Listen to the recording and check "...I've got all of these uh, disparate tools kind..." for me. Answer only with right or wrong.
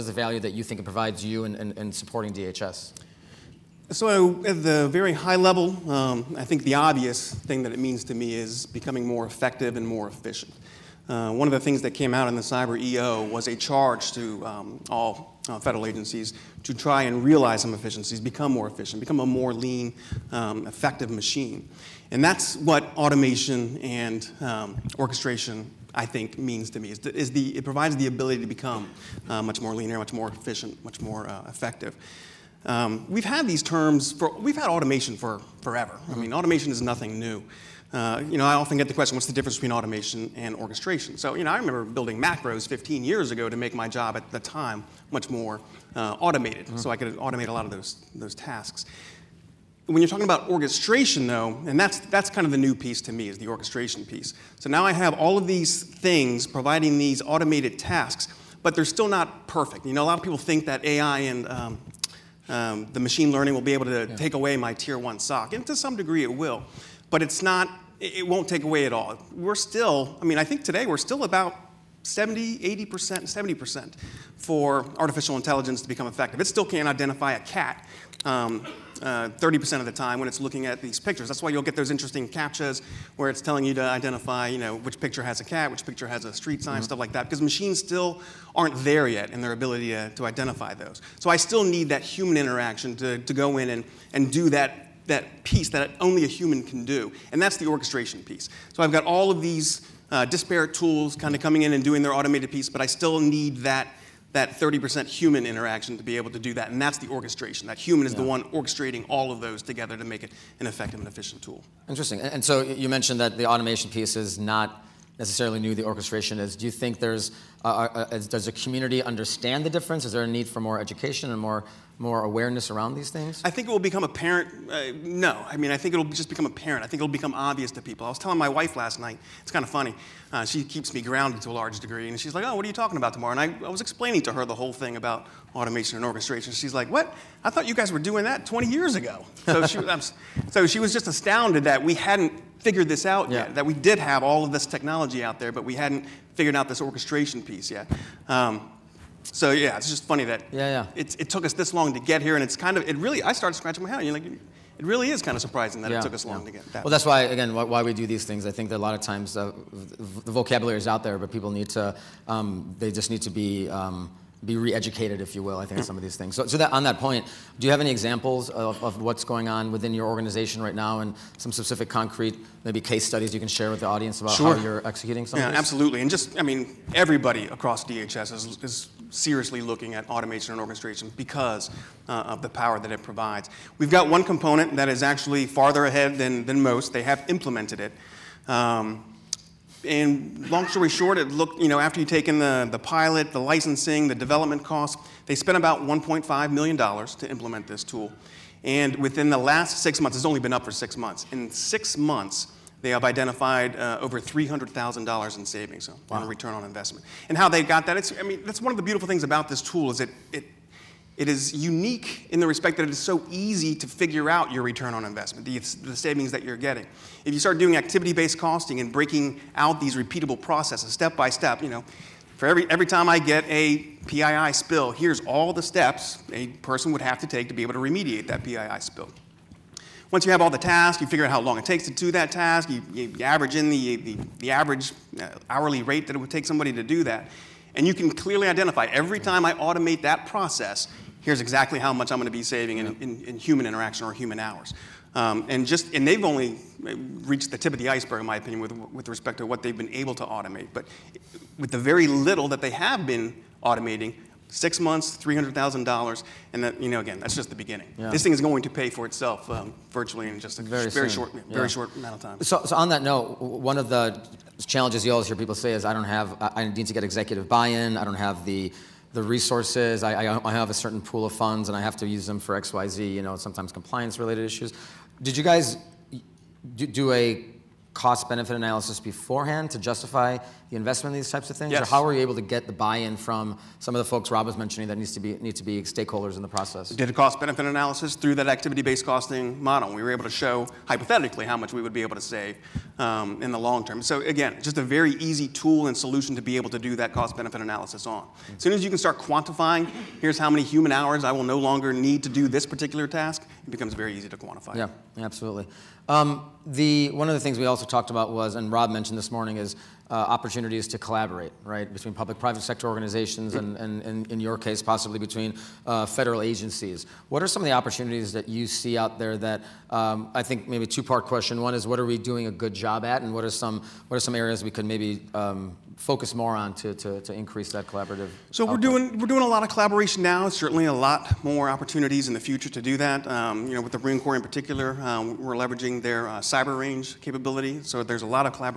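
right.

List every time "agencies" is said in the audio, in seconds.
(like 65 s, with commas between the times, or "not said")
15 s, 316 s.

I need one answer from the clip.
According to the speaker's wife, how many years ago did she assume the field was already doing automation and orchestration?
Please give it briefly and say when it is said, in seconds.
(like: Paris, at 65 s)
20 years ago, at 138 s.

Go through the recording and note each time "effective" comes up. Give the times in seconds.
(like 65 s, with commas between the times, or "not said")
9 s, 20 s, 31 s, 76 s, 110 s.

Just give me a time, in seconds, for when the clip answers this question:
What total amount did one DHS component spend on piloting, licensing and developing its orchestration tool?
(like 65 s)
195 s.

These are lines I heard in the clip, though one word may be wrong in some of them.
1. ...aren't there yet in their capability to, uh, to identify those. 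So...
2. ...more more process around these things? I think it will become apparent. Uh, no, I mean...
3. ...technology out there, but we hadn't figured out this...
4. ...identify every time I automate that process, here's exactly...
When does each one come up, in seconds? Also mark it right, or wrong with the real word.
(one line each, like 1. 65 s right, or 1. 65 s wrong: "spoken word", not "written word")
1. 88 s wrong: "ability", not "capability"
2. 121 s wrong: "awareness", not "process"
3. 144 s right
4. 238 s right.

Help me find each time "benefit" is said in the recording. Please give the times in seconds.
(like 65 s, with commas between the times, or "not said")
278 s, 287 s, 297 s.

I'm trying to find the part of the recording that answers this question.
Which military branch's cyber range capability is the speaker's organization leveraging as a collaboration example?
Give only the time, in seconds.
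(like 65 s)
333 s.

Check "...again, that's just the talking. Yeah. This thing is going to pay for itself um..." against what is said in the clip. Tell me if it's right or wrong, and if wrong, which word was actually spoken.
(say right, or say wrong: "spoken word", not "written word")
wrong: "beginning", not "talking".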